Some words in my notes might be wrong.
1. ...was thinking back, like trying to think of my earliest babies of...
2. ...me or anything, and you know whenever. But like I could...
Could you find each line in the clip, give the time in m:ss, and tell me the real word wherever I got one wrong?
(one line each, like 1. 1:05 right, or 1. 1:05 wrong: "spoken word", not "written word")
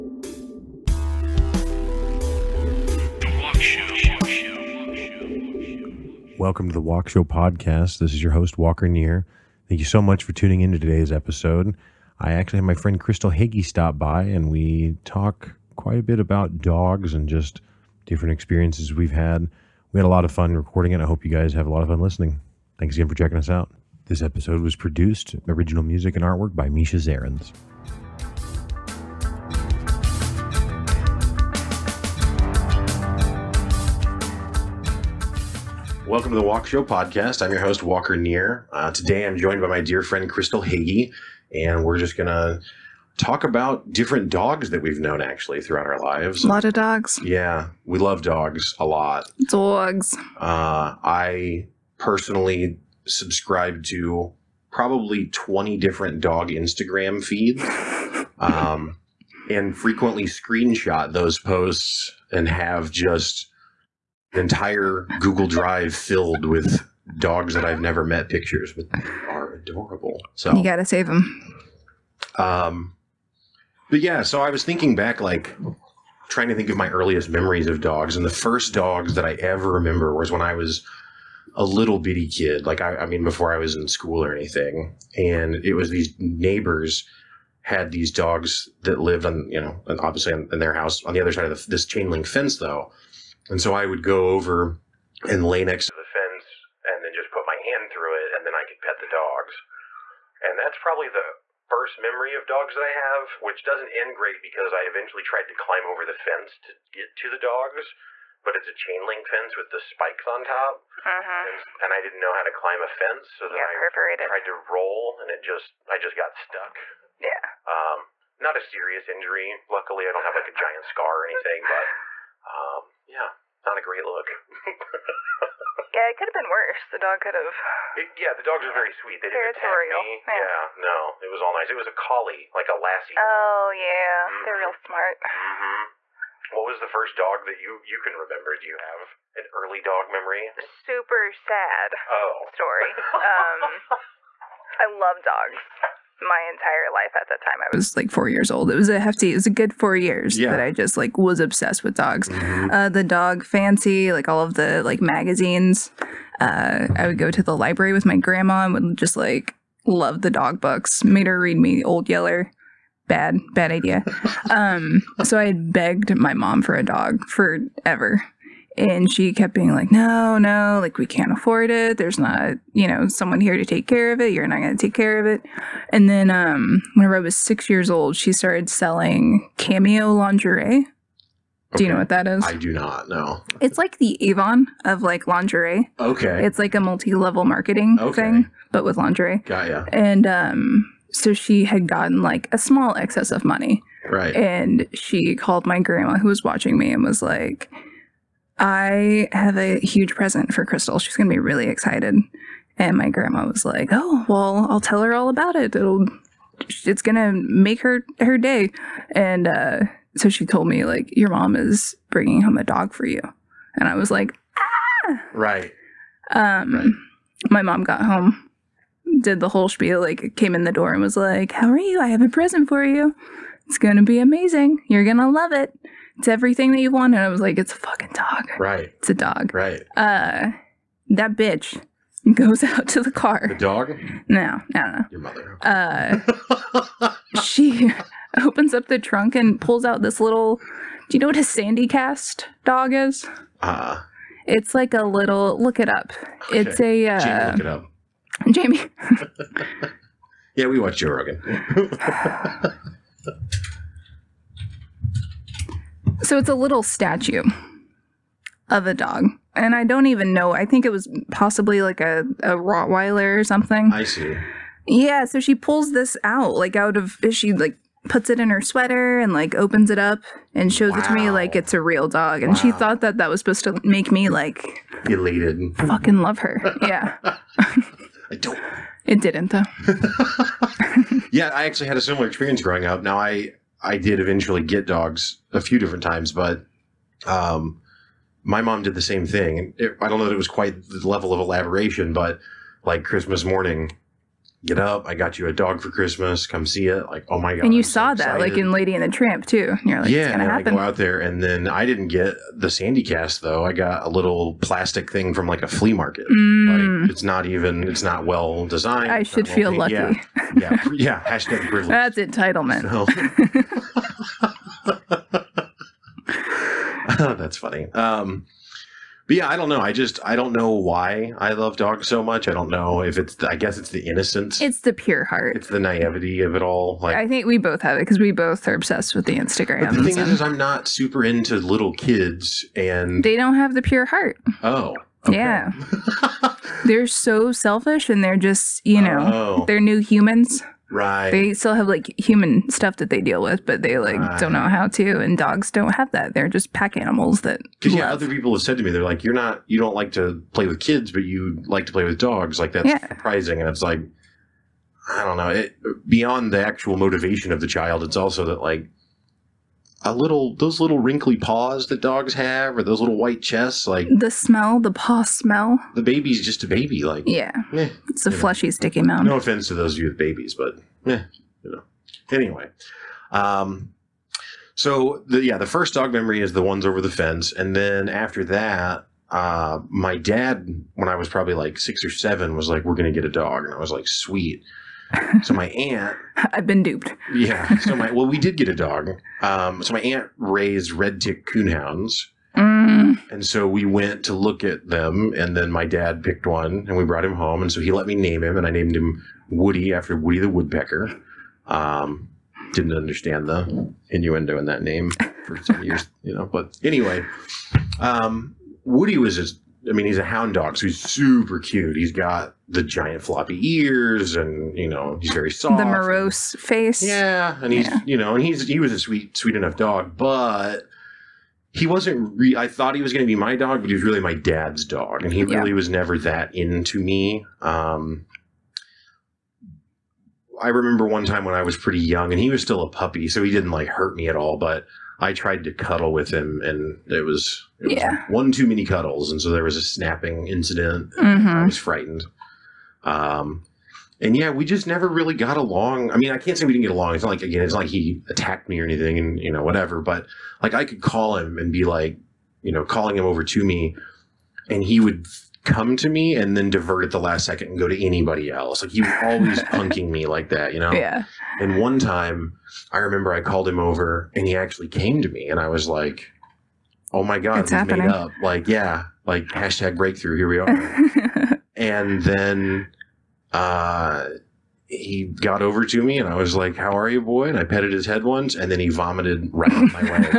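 1. 1:14 wrong: "memories", not "babies"
2. 7:28 wrong: "whatever", not "whenever".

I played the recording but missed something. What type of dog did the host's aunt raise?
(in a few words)
Red tick coonhounds.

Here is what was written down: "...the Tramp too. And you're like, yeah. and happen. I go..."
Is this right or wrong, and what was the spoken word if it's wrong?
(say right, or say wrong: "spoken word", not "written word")
right.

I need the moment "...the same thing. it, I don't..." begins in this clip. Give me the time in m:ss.
4:48.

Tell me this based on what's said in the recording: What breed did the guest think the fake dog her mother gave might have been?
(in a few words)
Rottweiler.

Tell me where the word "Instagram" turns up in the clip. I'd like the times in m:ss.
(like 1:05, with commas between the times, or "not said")
0:56, 5:29.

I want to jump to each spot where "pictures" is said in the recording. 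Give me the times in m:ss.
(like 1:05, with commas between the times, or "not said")
1:08.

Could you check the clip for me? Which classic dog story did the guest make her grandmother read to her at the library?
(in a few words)
Old Yeller.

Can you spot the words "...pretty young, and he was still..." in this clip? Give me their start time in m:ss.
7:11.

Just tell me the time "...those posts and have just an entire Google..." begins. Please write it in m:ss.
1:01.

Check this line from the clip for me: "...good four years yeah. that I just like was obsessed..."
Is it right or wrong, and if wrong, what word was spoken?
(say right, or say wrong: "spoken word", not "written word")
right.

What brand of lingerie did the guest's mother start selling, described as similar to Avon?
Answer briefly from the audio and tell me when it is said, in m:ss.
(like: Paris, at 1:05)
Cameo, at 2:59.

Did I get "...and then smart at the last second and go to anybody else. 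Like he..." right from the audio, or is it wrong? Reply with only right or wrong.
wrong.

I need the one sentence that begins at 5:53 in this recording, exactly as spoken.
surprising, and it's like, I don't know.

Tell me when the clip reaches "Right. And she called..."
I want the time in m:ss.
3:14.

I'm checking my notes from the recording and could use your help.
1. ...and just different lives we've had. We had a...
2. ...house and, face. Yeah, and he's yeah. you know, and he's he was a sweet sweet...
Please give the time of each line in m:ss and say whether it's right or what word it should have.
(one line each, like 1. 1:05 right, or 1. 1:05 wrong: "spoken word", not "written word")
1. 0:17 wrong: "experiences", not "lives"
2. 6:55 wrong: "morose", not "house".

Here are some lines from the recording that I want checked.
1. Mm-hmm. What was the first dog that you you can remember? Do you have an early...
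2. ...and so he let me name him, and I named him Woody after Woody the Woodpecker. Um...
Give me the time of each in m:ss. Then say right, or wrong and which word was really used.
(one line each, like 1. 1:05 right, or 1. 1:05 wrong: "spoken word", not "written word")
1. 2:15 right
2. 6:37 right.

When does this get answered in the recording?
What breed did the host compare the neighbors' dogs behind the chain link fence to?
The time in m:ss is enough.
2:11.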